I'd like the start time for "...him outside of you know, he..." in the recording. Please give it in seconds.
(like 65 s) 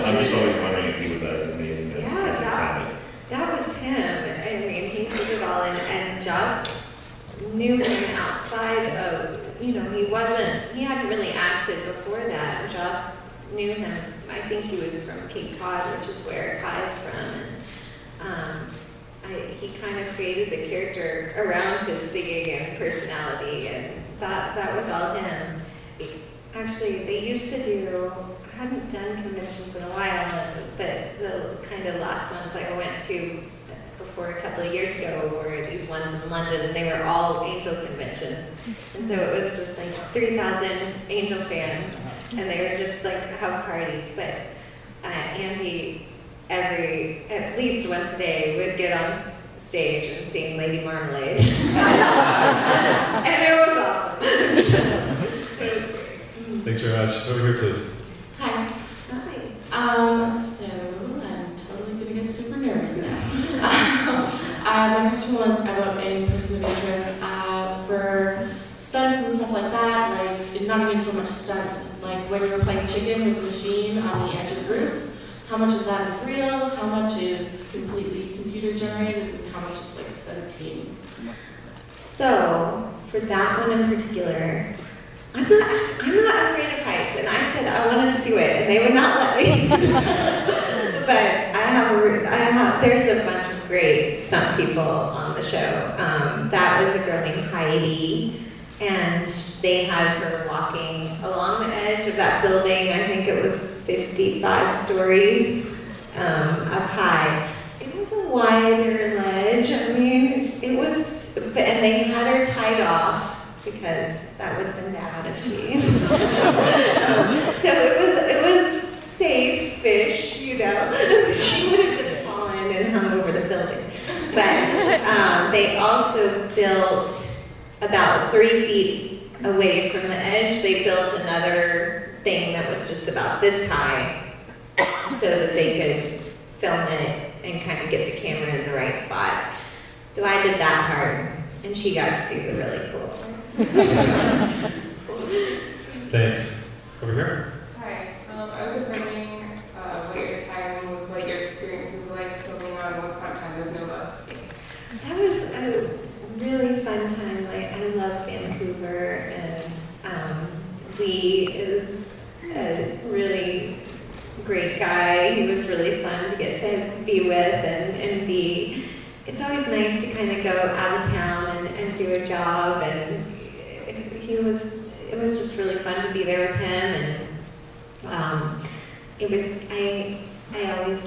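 7 s.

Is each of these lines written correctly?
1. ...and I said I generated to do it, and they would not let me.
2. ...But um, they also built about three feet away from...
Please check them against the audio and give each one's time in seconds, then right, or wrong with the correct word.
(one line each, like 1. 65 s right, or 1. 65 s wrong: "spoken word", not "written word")
1. 87 s wrong: "wanted", not "generated"
2. 124 s right.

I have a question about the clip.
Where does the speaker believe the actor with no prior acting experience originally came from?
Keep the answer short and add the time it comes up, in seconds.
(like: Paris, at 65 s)
Cape Cod, at 15 s.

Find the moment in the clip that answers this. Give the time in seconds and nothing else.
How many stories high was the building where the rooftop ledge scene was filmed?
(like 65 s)
103 s.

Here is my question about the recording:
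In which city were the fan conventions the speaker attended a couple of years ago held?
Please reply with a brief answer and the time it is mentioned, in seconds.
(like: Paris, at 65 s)
London, at 36 s.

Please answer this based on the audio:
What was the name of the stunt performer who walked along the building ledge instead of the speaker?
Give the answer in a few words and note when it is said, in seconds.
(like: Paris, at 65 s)
Heidi, at 97 s.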